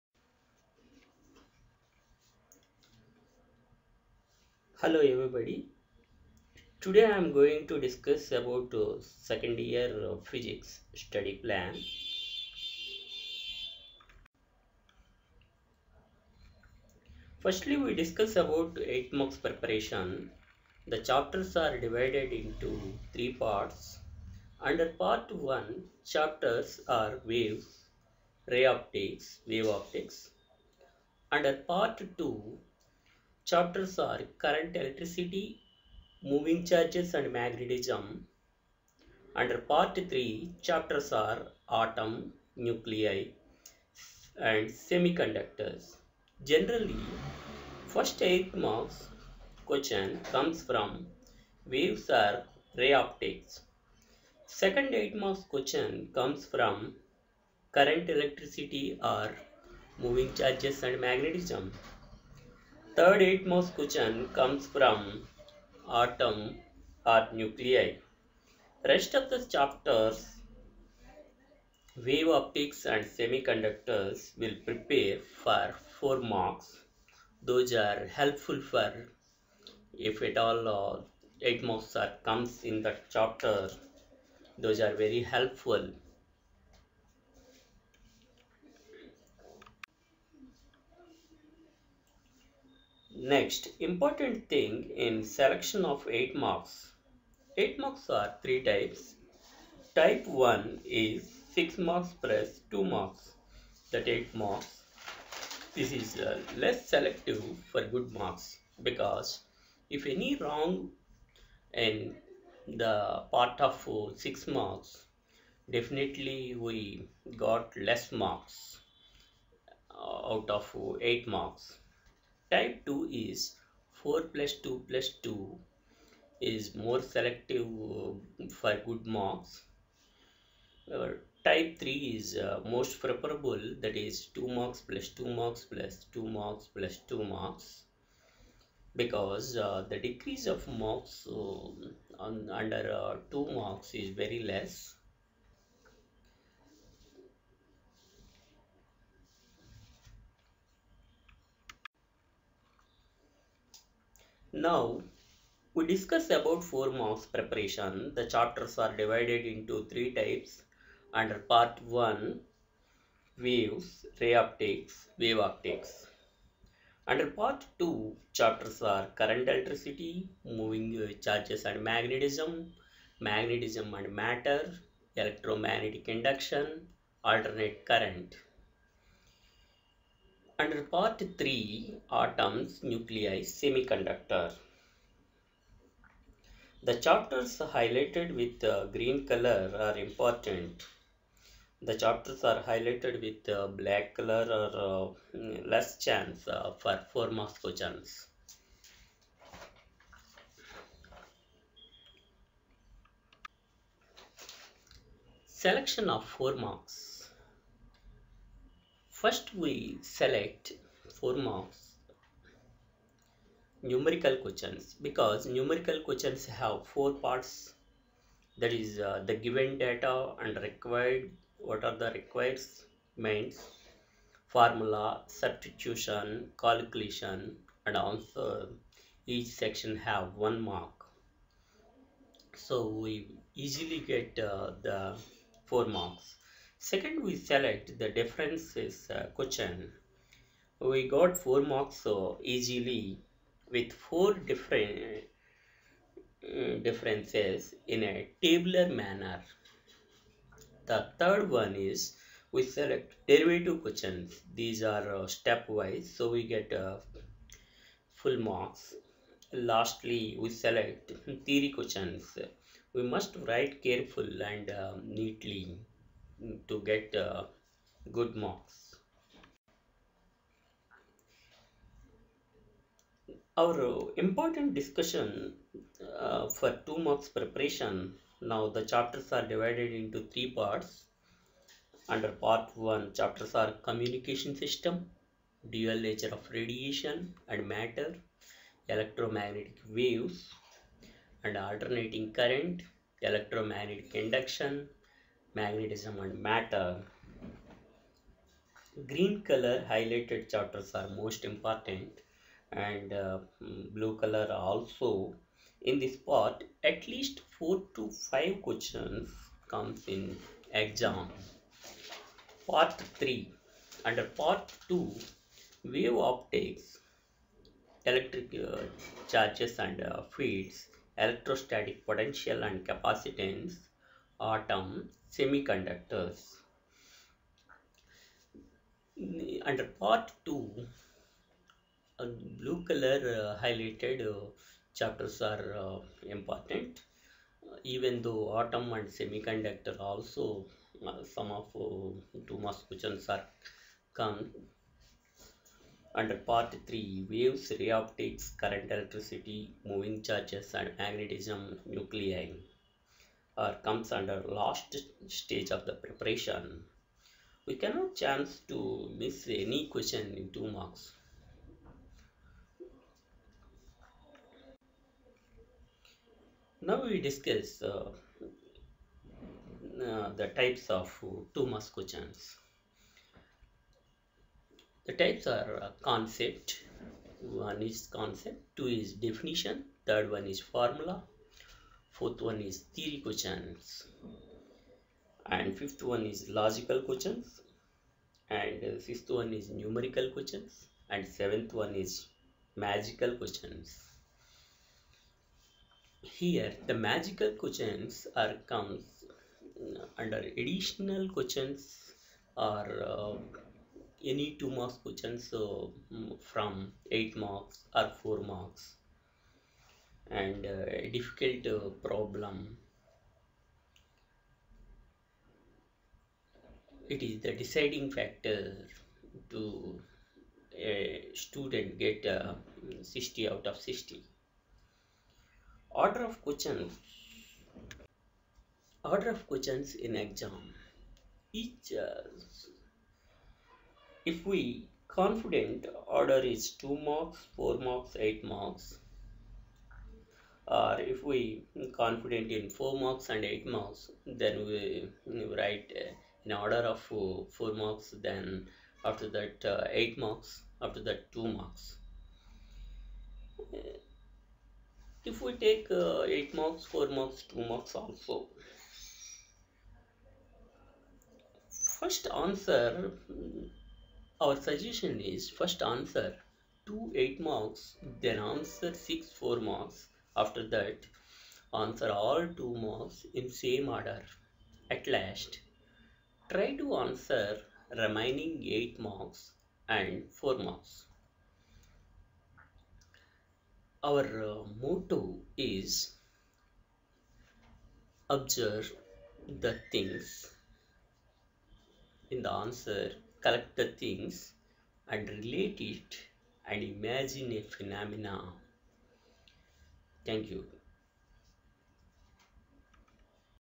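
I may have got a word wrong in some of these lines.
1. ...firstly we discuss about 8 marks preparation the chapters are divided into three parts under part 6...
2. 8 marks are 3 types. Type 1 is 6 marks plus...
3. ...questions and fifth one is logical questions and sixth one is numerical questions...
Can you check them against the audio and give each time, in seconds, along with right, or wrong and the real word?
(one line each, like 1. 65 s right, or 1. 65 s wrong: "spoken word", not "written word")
1. 17 s wrong: "1", not "6"
2. 97 s right
3. 383 s right.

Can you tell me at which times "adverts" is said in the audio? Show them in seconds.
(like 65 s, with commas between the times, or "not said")
not said.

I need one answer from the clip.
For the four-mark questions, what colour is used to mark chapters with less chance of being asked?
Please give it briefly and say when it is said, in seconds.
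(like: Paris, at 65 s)
black, at 193 s.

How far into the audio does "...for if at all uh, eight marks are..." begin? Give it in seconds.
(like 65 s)
78 s.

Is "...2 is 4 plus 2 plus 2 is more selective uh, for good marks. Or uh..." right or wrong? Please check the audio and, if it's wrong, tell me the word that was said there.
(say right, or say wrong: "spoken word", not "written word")
right.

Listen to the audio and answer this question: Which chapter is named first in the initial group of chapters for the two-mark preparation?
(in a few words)
communication system.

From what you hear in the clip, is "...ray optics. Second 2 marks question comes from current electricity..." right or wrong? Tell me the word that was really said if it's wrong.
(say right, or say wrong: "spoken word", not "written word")
wrong: "8", not "2".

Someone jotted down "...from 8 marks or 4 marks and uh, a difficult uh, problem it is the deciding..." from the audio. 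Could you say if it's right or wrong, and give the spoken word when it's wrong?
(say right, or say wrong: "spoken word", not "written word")
right.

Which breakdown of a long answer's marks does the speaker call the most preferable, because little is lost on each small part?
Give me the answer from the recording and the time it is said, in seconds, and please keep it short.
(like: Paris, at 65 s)
2+2+2+2, at 134 s.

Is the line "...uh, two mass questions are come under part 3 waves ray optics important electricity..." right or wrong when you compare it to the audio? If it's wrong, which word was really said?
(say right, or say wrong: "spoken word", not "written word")
wrong: "current", not "important".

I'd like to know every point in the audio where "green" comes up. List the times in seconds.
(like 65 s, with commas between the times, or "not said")
188 s, 299 s.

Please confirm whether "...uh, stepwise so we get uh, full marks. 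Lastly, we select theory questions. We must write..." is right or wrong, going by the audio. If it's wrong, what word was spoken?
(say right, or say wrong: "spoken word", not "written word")
right.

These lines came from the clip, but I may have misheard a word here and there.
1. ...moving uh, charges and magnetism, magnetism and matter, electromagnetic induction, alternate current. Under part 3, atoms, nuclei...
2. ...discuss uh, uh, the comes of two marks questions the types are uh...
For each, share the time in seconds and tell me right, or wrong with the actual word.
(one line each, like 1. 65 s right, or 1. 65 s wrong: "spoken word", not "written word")
1. 170 s right
2. 367 s wrong: "types", not "comes".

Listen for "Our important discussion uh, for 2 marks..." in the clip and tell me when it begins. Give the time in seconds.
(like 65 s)
273 s.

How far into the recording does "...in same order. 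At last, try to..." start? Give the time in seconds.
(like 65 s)
473 s.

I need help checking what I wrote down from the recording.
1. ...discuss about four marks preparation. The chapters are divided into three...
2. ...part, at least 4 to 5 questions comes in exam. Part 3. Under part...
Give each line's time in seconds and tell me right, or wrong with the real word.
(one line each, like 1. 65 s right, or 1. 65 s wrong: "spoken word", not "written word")
1. 155 s right
2. 306 s right.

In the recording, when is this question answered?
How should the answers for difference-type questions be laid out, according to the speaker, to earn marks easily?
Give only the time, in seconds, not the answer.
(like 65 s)
248 s.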